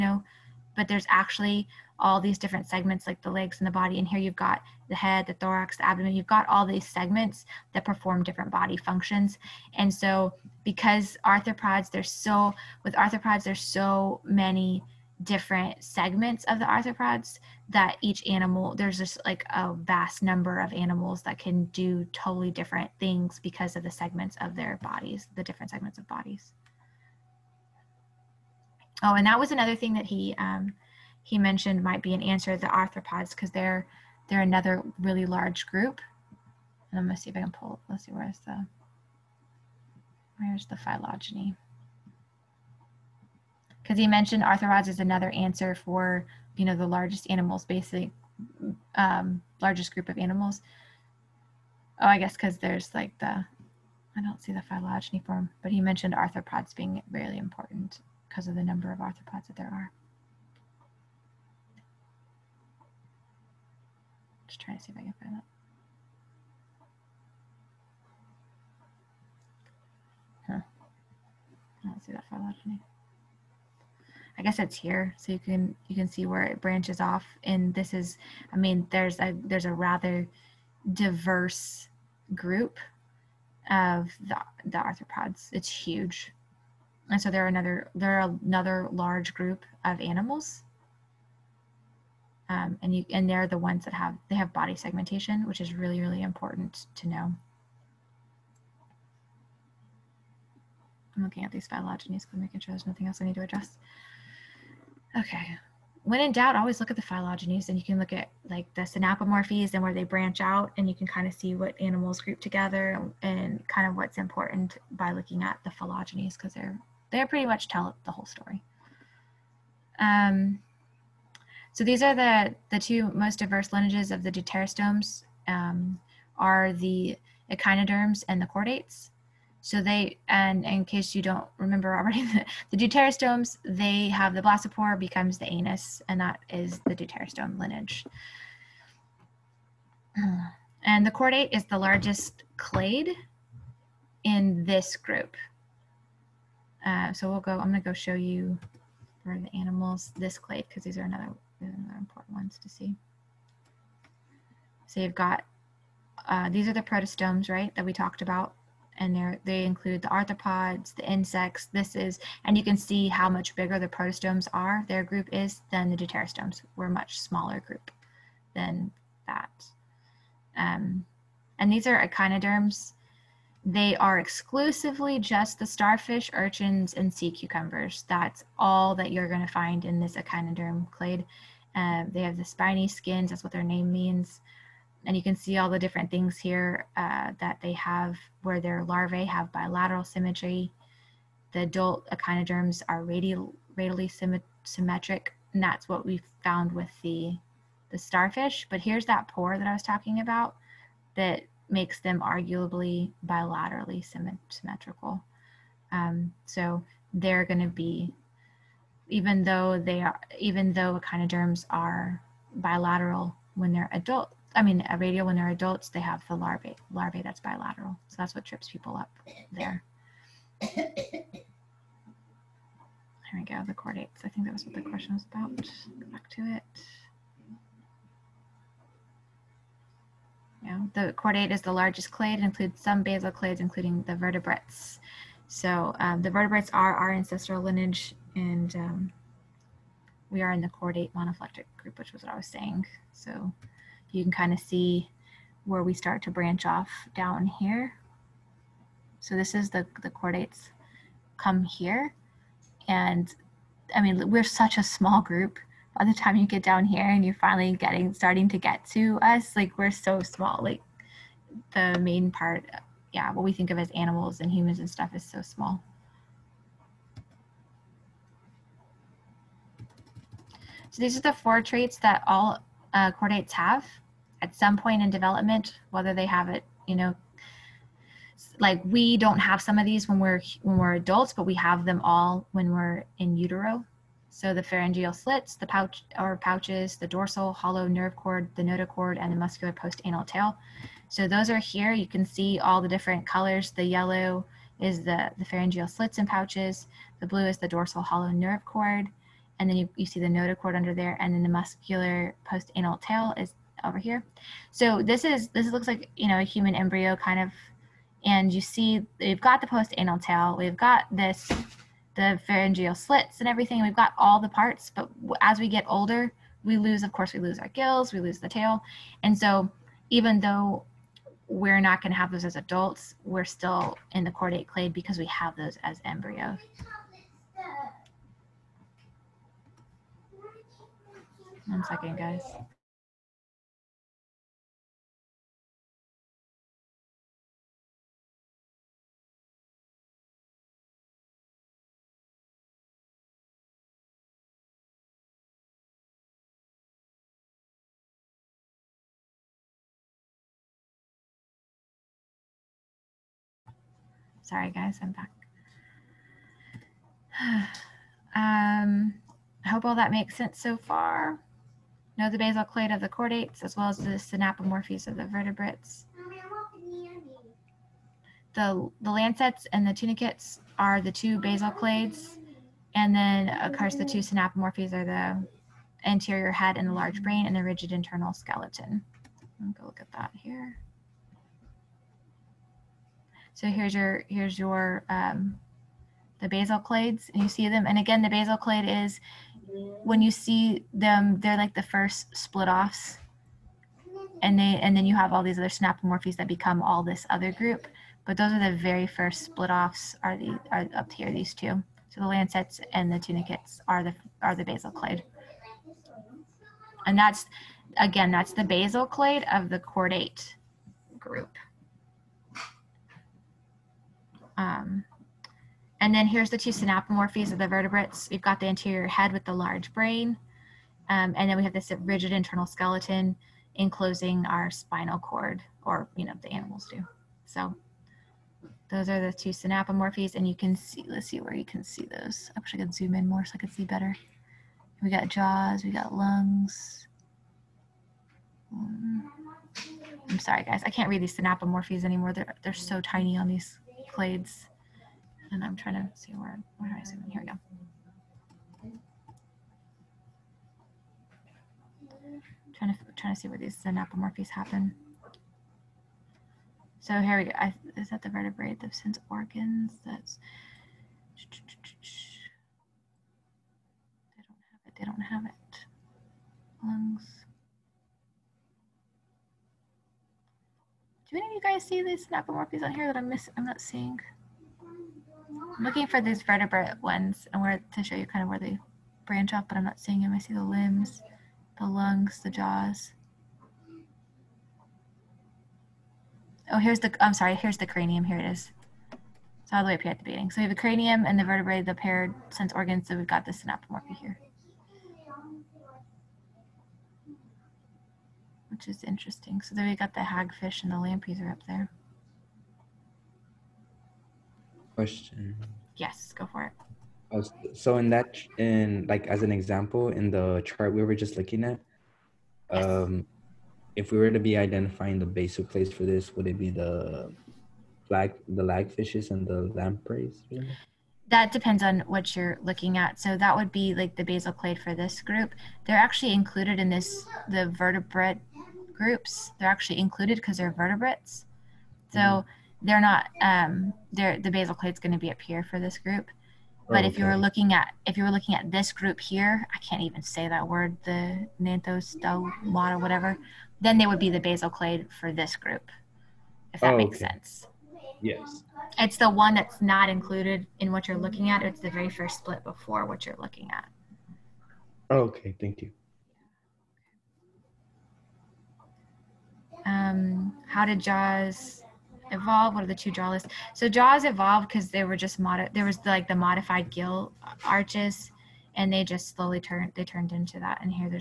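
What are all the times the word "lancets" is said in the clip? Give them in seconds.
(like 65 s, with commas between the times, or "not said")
369 s, 402 s.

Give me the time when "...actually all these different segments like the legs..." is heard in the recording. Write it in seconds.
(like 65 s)
1 s.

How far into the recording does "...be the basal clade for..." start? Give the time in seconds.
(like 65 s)
544 s.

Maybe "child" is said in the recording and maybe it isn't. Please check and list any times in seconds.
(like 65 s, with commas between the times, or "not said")
not said.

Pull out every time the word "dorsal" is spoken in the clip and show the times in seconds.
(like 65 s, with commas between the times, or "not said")
287 s, 297 s.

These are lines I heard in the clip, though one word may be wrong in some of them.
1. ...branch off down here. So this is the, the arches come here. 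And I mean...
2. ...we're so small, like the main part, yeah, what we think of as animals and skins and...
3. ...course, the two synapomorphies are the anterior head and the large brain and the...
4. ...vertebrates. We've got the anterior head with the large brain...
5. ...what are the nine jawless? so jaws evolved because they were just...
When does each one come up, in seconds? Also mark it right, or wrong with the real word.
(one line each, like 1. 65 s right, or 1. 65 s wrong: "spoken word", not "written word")
1. 246 s wrong: "chordates", not "arches"
2. 259 s wrong: "humans", not "skins"
3. 373 s right
4. 417 s right
5. 562 s wrong: "two", not "nine".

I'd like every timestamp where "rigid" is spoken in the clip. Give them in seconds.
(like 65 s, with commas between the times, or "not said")
377 s, 422 s.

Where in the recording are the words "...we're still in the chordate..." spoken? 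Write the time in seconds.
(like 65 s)
323 s.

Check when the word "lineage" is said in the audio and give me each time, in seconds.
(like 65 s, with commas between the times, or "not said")
123 s, 137 s, 237 s.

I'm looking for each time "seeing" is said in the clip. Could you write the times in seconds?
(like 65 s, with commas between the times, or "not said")
473 s, 479 s.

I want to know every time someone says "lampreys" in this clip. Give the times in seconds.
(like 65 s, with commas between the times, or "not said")
500 s, 519 s.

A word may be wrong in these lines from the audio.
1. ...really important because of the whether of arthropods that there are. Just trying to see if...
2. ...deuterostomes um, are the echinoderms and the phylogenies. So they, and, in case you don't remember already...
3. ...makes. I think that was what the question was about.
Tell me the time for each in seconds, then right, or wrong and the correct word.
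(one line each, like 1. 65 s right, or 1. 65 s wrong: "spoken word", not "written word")
1. 57 s wrong: "number", not "whether"
2. 124 s wrong: "chordates", not "phylogenies"
3. 223 s wrong: "chordates", not "makes".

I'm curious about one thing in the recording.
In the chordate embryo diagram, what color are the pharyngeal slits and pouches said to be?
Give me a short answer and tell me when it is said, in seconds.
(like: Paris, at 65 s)
Yellow, at 293 s.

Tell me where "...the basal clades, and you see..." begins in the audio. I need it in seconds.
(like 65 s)
386 s.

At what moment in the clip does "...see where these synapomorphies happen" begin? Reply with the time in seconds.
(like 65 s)
453 s.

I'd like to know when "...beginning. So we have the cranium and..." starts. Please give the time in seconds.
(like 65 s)
490 s.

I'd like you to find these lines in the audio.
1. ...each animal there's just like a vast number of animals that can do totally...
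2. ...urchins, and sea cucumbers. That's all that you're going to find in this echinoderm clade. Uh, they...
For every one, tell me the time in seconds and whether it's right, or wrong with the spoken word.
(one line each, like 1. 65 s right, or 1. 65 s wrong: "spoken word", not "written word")
1. 18 s right
2. 176 s right.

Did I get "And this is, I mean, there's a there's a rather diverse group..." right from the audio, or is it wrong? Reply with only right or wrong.
right.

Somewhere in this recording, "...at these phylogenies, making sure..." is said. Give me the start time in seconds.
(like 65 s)
101 s.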